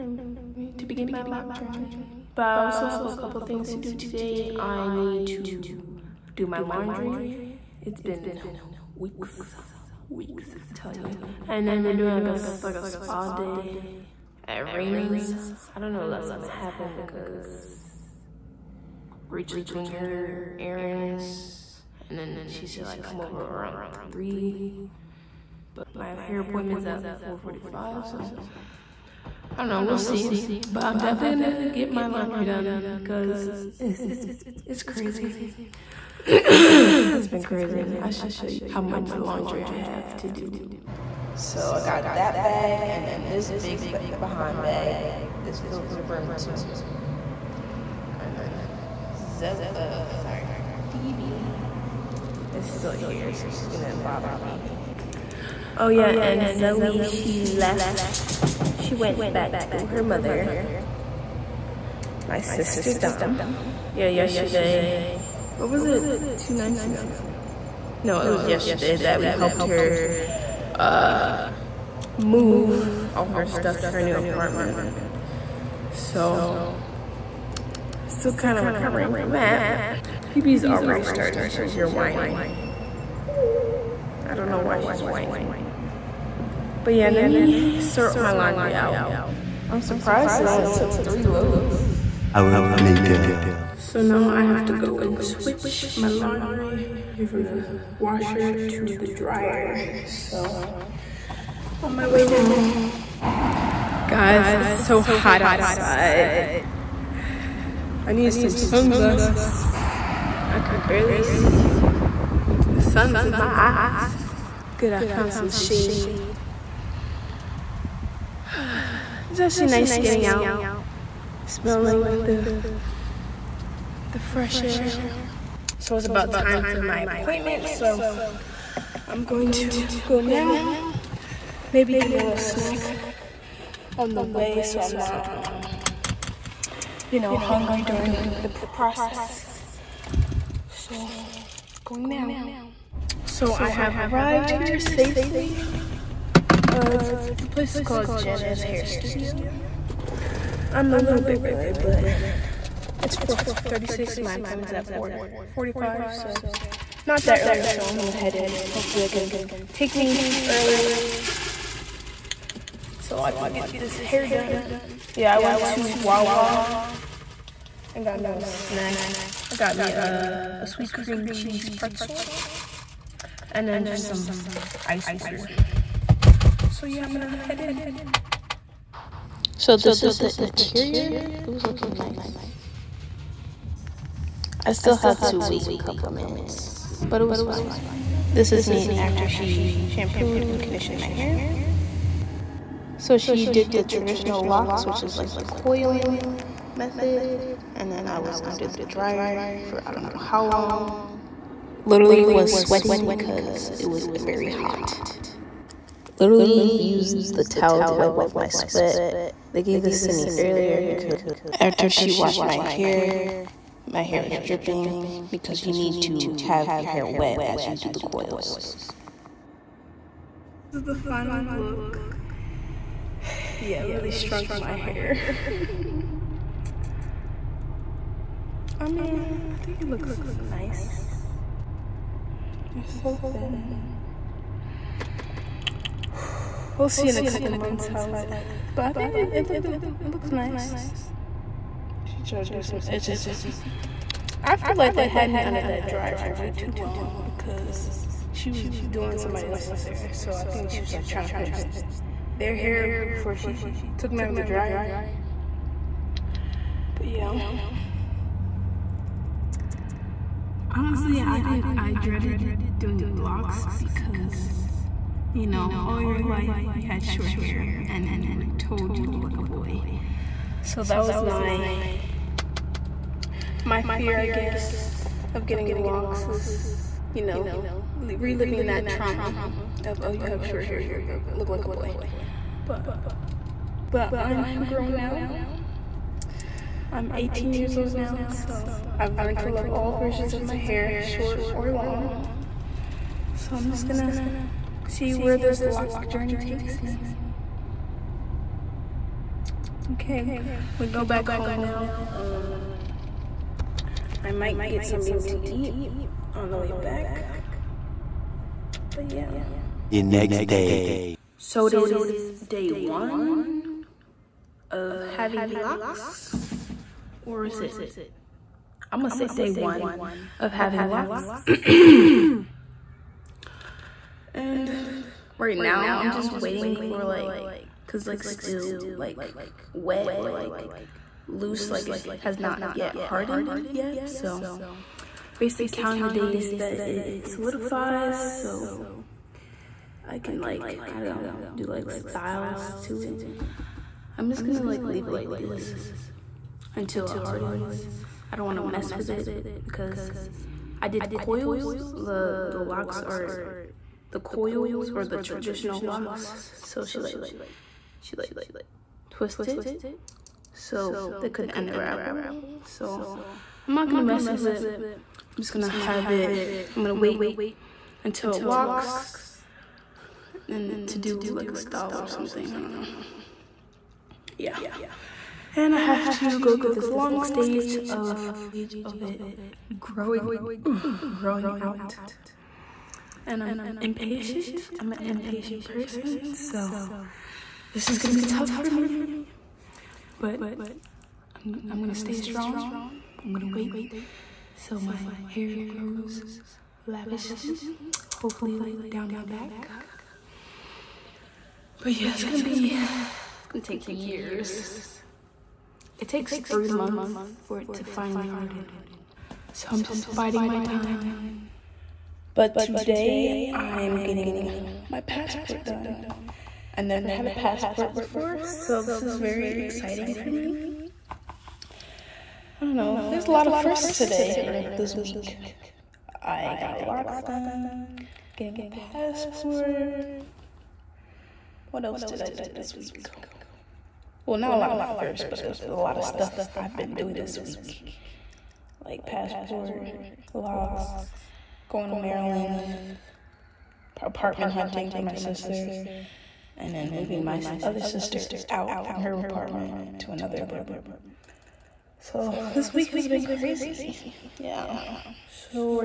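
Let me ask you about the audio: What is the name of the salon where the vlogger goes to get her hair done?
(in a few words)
Jenna's Hair Studio.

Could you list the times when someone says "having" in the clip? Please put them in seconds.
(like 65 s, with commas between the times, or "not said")
315 s, 320 s.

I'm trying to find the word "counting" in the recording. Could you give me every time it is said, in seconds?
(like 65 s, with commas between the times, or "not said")
335 s.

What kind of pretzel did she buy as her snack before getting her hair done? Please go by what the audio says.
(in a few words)
sweet cream cheese pretzel.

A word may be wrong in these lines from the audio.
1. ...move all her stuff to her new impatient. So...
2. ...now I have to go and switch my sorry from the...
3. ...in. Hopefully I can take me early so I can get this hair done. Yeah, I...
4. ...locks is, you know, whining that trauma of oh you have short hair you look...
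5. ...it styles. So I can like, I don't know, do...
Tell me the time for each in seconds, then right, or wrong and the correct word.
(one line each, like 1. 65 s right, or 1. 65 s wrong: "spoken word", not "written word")
1. 72 s wrong: "apartment", not "impatient"
2. 94 s wrong: "laundry", not "sorry"
3. 158 s right
4. 275 s wrong: "reliving", not "whining"
5. 336 s wrong: "solidifies", not "styles".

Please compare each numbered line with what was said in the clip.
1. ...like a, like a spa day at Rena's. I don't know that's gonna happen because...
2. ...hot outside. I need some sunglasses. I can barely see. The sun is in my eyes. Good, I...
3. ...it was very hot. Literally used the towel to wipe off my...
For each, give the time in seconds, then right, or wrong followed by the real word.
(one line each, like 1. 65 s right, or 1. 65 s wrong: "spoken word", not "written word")
1. 12 s right
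2. 105 s right
3. 203 s right.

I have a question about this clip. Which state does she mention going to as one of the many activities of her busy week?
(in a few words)
Maryland.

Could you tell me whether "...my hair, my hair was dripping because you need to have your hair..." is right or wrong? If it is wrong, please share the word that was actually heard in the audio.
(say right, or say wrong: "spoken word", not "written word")
right.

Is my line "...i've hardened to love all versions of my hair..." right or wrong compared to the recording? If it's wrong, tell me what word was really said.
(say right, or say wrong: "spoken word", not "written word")
wrong: "learned", not "hardened".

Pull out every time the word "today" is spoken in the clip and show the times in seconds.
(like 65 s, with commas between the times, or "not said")
3 s, 412 s, 423 s.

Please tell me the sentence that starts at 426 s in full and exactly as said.
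I got locks done, getting a passport, what else did I do this week?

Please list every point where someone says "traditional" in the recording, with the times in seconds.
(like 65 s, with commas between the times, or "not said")
193 s, 355 s.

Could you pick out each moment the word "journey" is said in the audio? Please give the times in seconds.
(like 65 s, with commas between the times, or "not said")
1 s, 296 s.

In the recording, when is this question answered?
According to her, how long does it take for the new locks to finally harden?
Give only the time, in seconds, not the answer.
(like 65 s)
406 s.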